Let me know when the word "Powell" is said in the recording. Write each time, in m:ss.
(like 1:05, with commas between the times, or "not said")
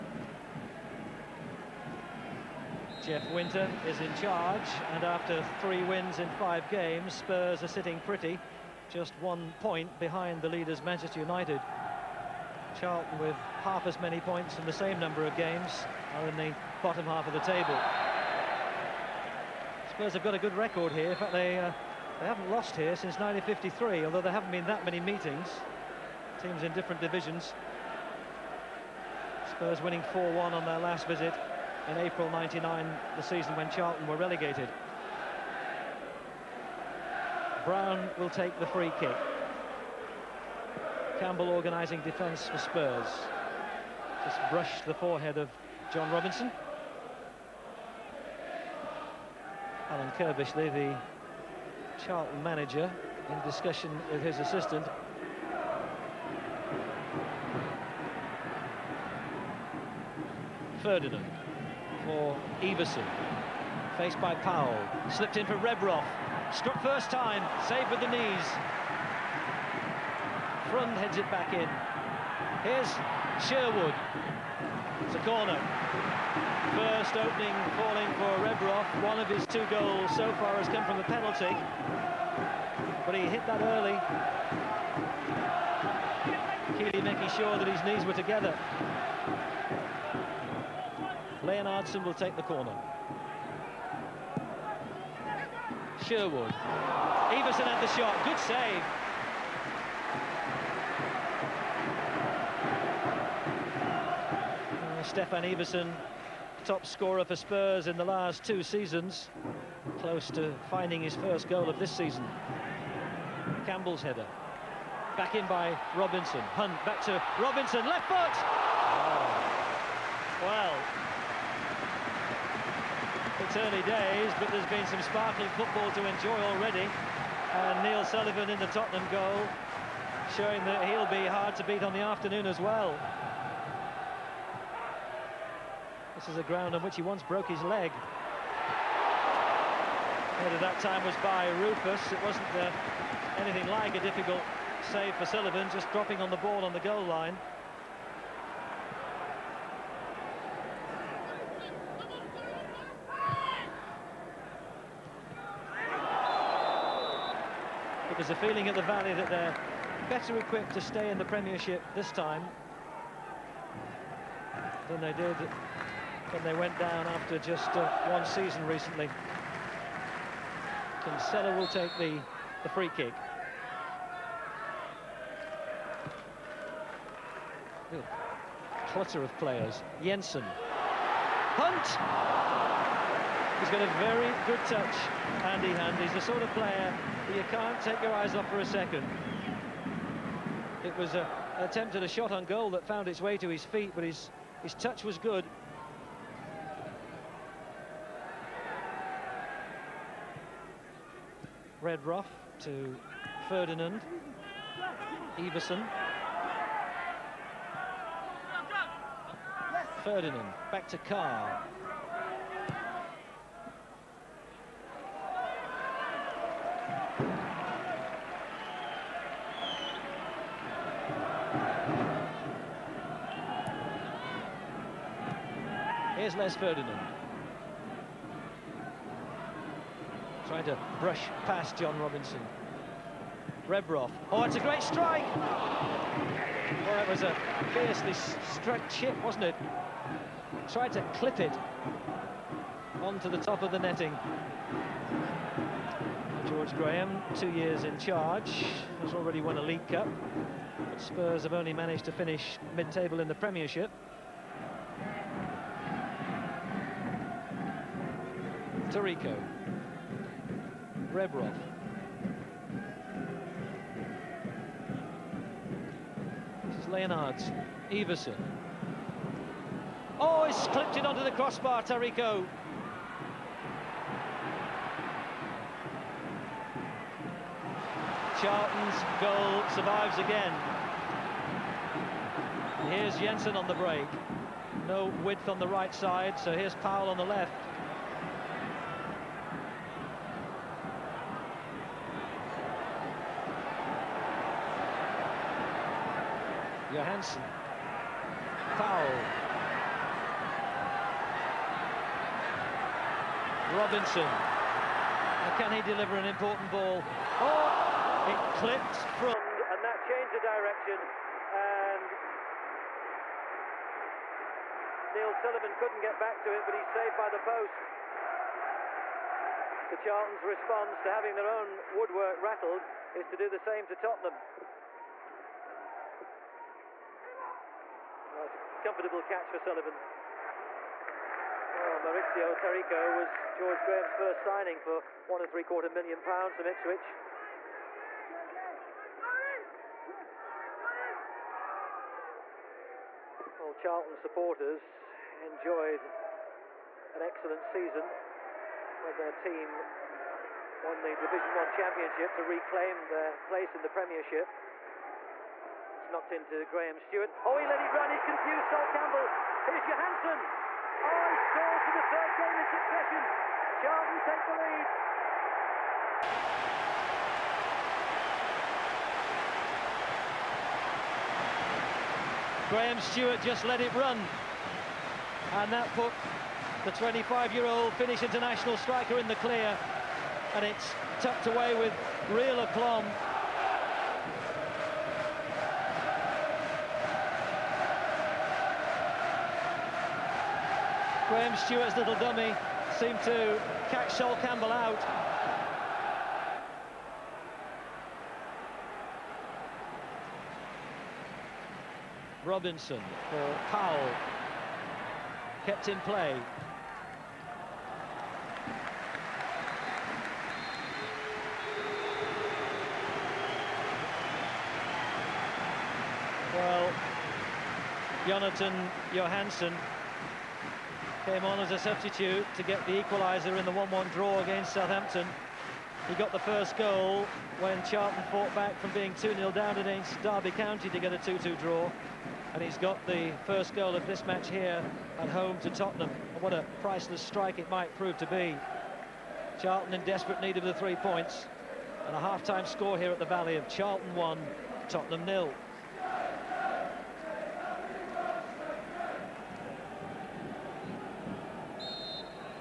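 1:04, 4:46, 6:43.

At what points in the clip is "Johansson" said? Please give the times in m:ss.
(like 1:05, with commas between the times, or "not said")
5:59, 6:59.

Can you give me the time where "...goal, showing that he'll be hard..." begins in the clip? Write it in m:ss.
2:09.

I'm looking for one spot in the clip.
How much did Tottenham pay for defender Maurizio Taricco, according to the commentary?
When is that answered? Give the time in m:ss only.
5:35.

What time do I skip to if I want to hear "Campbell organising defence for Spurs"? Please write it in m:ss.
0:41.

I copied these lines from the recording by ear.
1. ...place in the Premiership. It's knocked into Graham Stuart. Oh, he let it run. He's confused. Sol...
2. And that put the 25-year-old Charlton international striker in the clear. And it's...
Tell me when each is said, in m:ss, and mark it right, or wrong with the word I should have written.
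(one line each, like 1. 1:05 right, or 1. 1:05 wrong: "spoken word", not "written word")
1. 5:53 right
2. 6:15 wrong: "Finnish", not "Charlton".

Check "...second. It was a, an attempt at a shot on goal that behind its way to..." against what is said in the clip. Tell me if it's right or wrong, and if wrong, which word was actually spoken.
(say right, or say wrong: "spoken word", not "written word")
wrong: "found", not "behind".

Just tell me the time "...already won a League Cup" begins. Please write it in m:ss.
4:09.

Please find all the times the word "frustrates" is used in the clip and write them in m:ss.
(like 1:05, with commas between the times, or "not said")
not said.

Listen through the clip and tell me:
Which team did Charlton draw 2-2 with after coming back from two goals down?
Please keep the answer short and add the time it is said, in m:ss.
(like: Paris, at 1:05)
Derby County, at 7:10.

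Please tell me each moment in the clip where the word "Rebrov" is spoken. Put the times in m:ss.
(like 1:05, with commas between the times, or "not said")
1:05, 1:18, 3:21, 3:53, 4:21.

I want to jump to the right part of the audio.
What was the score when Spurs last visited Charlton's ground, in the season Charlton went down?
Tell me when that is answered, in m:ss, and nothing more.
0:30.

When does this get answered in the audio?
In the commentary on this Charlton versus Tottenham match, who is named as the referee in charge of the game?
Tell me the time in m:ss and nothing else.
0:03.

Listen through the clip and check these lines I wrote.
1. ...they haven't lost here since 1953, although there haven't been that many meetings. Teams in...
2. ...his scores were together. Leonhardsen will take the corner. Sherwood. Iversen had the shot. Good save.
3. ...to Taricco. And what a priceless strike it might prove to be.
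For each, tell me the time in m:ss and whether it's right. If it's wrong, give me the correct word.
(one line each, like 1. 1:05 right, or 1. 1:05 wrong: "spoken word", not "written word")
1. 0:22 right
2. 1:27 wrong: "knees", not "scores"
3. 7:15 wrong: "Tottenham", not "Taricco".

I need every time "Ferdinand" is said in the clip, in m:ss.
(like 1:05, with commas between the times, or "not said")
1:00, 3:23, 3:30, 3:46.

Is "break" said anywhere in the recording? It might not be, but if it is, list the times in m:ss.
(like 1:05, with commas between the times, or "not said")
4:43.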